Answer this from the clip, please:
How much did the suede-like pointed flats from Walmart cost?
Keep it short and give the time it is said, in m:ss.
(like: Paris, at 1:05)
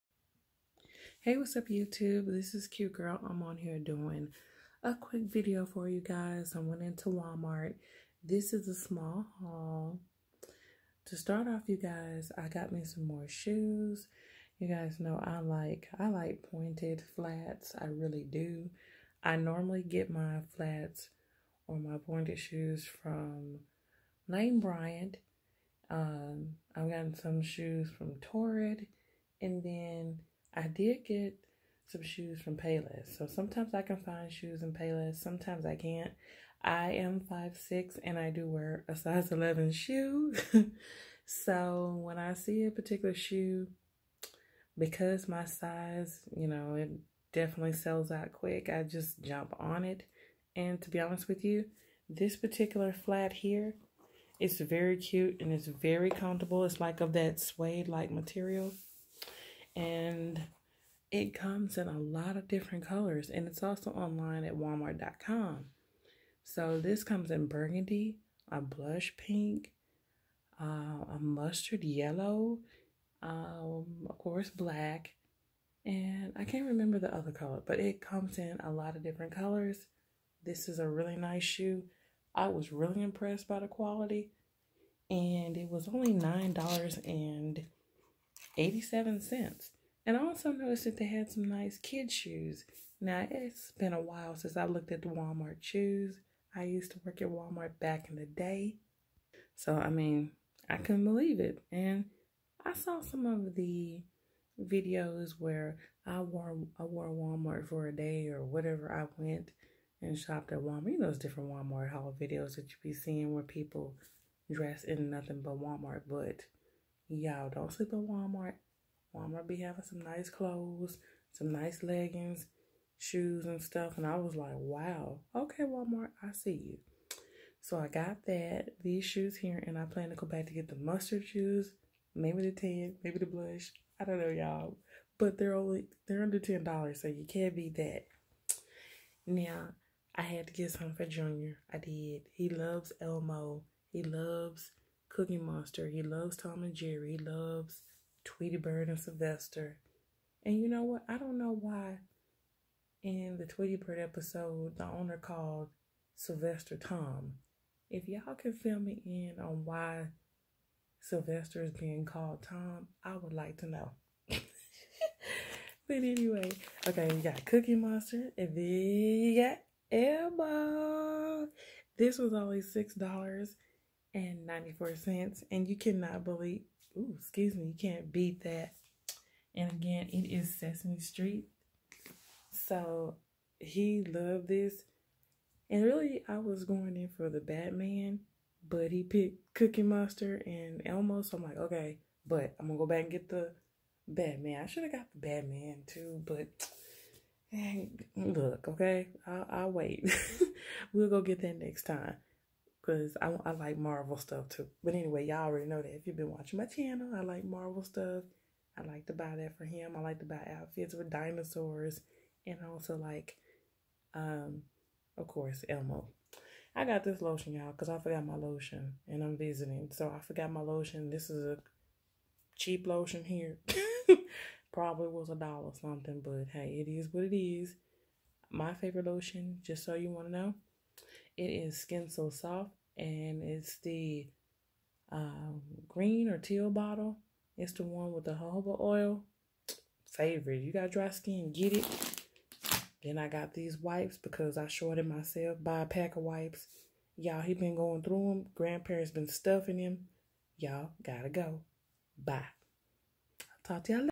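$9.87, at 1:26.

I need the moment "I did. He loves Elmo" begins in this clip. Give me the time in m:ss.
2:21.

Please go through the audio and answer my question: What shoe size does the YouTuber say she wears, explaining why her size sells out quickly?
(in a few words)
11.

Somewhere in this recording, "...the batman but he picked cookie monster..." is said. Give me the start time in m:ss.
3:07.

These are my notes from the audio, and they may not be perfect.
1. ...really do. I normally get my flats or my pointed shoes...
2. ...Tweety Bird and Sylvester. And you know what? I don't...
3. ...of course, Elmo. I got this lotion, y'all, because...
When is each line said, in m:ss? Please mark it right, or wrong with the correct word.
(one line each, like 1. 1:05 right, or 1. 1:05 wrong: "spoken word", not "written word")
1. 0:17 right
2. 2:28 right
3. 3:35 right.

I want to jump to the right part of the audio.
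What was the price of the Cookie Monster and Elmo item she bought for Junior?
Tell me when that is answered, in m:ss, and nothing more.
2:52.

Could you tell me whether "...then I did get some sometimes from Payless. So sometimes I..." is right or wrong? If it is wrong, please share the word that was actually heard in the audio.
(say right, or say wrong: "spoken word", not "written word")
wrong: "shoes", not "sometimes".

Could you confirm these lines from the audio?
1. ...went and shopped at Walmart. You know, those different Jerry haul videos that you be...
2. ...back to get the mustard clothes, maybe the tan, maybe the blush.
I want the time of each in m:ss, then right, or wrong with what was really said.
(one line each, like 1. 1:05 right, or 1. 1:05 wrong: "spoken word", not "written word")
1. 1:49 wrong: "Walmart", not "Jerry"
2. 2:10 wrong: "shoes", not "clothes".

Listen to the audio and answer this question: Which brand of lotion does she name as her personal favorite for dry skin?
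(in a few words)
Skin So Soft.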